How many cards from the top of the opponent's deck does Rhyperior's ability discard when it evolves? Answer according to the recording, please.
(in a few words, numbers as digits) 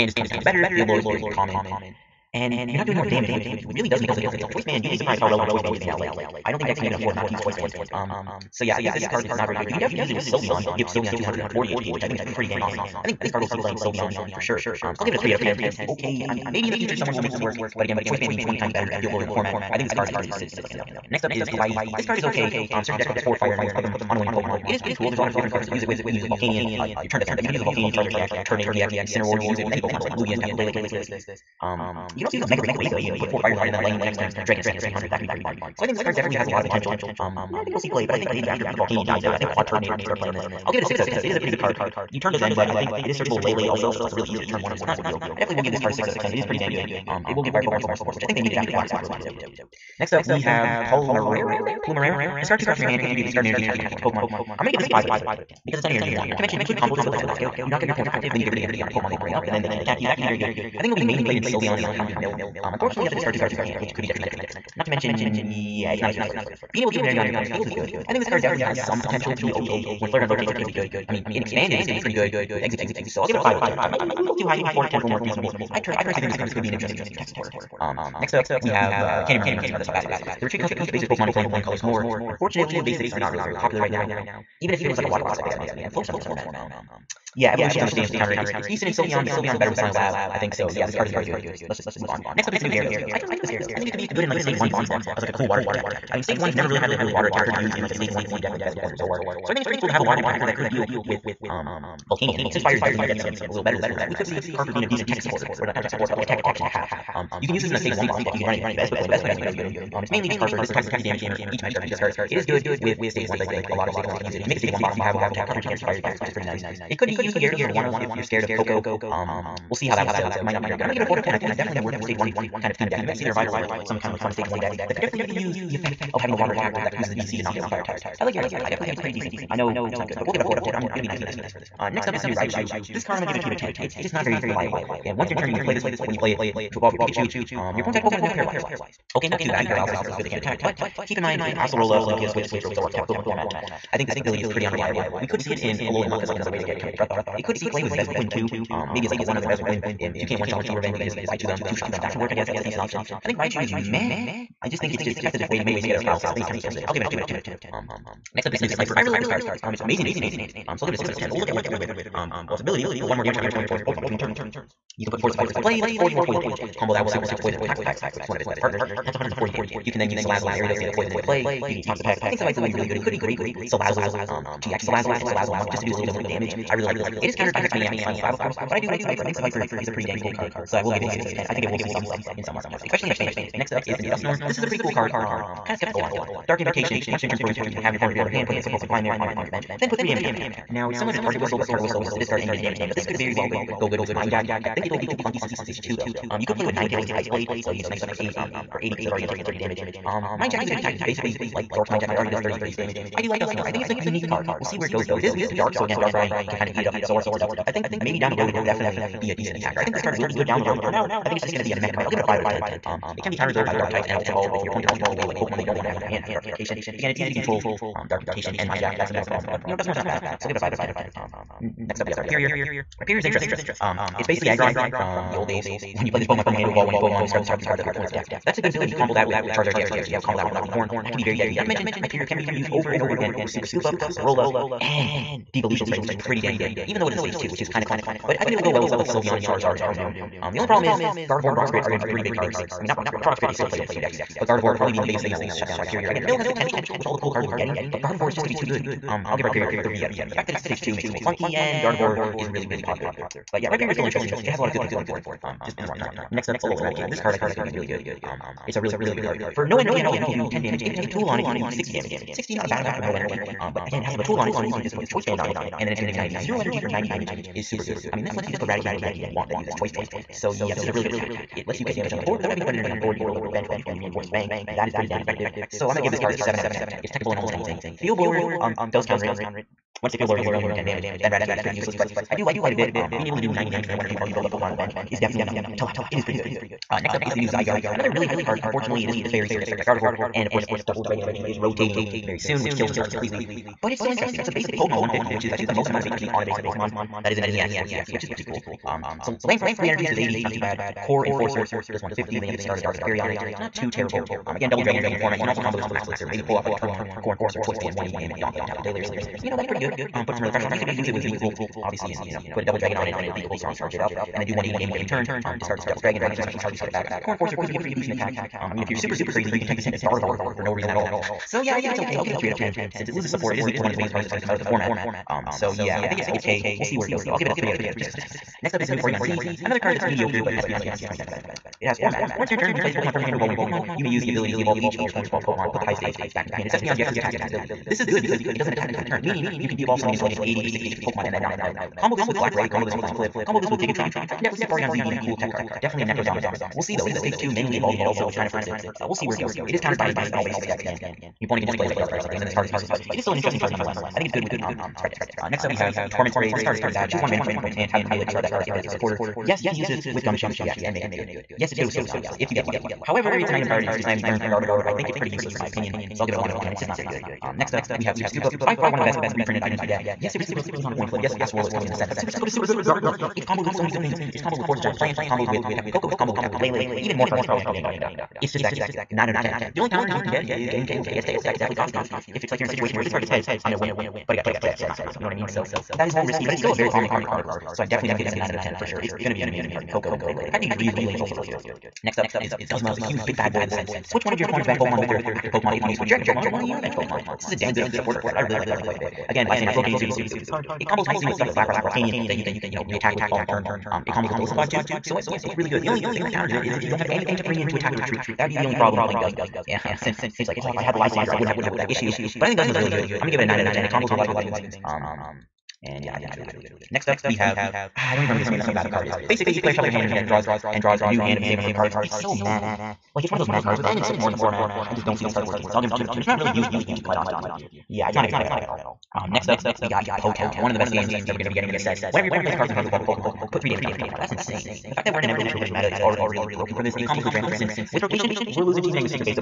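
3.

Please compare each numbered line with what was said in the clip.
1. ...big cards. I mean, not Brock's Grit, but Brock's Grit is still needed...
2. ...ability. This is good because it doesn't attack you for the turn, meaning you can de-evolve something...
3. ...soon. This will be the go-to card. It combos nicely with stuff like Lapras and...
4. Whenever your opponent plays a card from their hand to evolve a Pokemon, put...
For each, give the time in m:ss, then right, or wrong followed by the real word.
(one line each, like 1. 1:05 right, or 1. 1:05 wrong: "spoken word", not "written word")
1. 4:02 wrong: "played", not "needed"
2. 5:37 right
3. 6:39 right
4. 7:12 right.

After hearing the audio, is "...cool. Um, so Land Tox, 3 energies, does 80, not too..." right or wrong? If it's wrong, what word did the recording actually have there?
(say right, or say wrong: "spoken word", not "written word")
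wrong: "Crush", not "Tox".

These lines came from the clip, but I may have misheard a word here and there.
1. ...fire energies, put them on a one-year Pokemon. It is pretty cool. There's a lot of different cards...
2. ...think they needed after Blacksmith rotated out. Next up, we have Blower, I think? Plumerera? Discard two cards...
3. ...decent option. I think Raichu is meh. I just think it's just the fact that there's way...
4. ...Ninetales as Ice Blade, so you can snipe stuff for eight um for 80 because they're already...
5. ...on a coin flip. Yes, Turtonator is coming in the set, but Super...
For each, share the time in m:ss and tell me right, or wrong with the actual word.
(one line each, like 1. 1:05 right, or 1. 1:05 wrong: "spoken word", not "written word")
1. 0:23 right
2. 0:48 wrong: "Palmerera", not "Blower"
3. 2:32 right
4. 3:16 right
5. 6:10 wrong: "Acerola", not "Turtonator".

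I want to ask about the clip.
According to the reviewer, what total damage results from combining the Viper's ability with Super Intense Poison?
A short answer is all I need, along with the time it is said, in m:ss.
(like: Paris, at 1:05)
140, at 2:49.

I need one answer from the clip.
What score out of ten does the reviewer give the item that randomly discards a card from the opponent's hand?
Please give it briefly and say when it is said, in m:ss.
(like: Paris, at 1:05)
1 out of 10, at 6:06.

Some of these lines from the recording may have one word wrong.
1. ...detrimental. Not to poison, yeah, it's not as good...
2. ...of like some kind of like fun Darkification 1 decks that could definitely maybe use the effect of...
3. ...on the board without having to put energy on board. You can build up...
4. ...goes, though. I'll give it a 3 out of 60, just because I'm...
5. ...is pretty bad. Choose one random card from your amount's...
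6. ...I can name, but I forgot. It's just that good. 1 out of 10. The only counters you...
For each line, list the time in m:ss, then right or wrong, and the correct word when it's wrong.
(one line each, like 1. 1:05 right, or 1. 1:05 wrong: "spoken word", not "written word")
1. 1:04 wrong: "mention", not "poison"
2. 2:03 wrong: "Stage", not "Darkification"
3. 4:32 right
4. 5:27 wrong: "10", not "60"
5. 5:56 wrong: "opponent", not "amount"
6. 6:17 wrong: "9", not "1".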